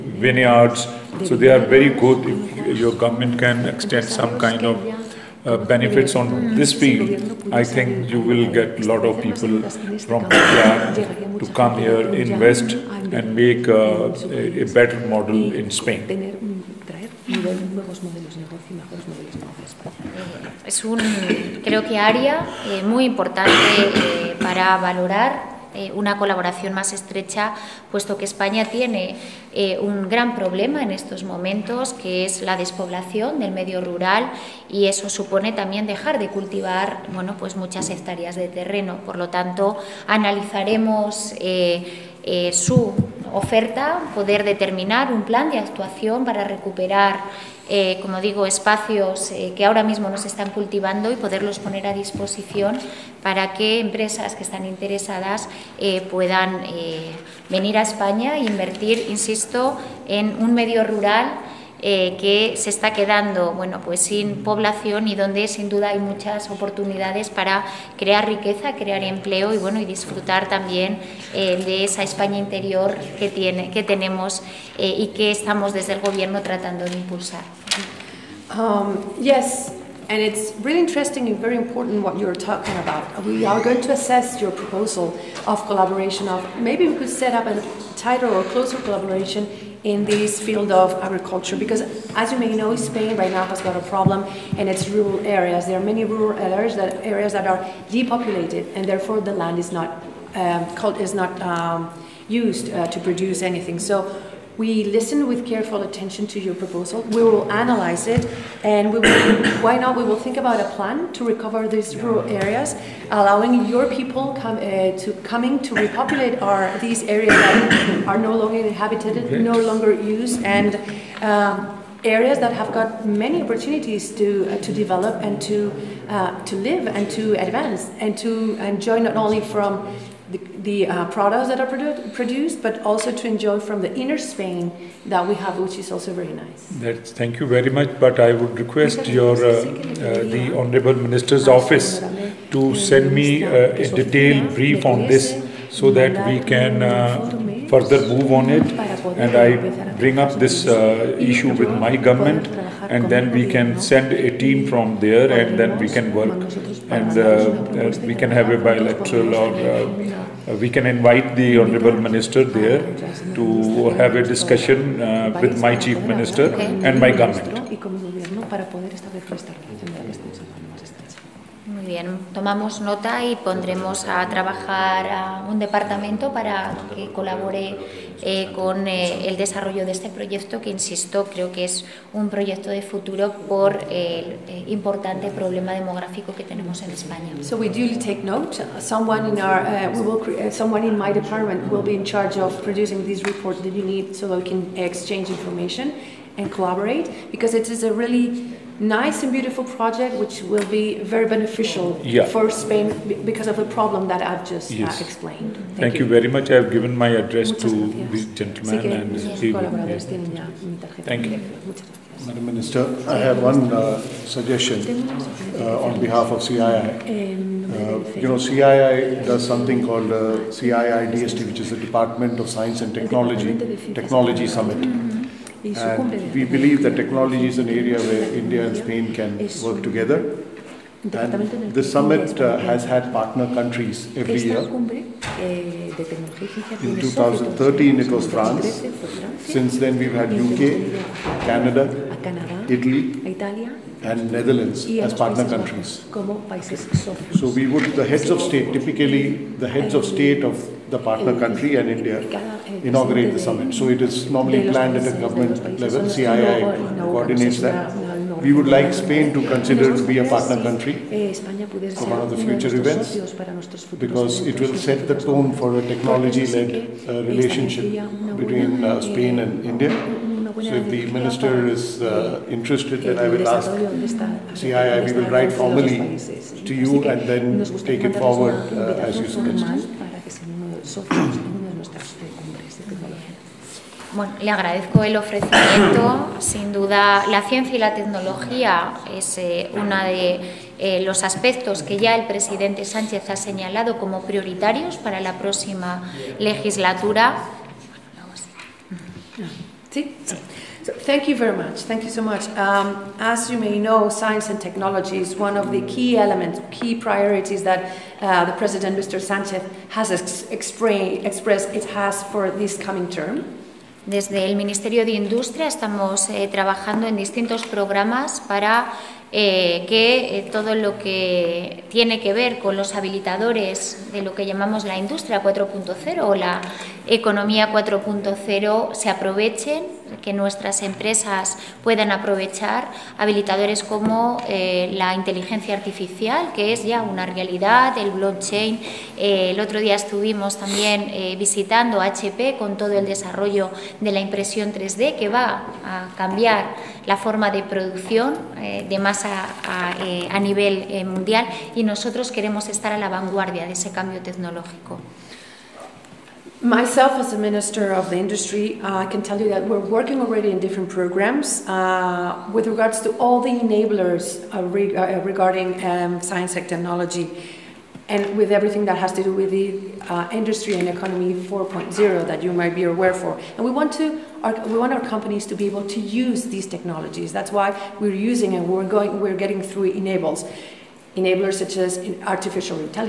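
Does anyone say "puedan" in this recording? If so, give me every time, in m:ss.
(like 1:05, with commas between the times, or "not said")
0:56, 5:31.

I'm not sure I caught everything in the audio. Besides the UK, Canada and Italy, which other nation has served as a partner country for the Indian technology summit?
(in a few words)
Netherlands.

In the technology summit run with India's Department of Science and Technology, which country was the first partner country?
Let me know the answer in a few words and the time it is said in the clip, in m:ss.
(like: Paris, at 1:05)
France, at 3:58.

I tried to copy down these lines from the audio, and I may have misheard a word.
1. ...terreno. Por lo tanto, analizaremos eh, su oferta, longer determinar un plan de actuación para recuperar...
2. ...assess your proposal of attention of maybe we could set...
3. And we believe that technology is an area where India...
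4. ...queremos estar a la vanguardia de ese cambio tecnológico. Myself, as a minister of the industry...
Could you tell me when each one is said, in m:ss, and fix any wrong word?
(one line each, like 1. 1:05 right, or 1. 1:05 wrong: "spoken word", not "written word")
1. 0:38 wrong: "poder", not "longer"
2. 1:23 wrong: "collaboration", not "attention"
3. 3:45 right
4. 5:52 right.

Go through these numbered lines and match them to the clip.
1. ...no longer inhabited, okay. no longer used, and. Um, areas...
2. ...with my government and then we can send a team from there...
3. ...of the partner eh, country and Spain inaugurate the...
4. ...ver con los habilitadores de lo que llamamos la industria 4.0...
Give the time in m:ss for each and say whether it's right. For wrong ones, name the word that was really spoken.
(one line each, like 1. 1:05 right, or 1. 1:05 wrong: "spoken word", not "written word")
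1. 1:58 right
2. 2:31 right
3. 4:10 wrong: "India", not "Spain"
4. 5:22 right.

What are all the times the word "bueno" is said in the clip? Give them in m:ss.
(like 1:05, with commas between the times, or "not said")
0:37, 1:03, 1:09, 4:44.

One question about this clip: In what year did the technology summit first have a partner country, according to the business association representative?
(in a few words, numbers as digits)
2013.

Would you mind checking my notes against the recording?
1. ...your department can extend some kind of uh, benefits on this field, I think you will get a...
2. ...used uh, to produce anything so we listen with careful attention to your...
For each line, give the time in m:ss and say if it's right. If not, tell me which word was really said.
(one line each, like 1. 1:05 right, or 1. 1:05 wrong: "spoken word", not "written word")
1. 0:02 wrong: "government", not "department"
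2. 1:42 right.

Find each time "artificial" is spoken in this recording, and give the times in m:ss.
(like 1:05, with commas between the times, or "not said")
5:35, 6:22.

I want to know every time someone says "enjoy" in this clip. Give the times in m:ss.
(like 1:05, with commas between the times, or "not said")
2:08, 2:13.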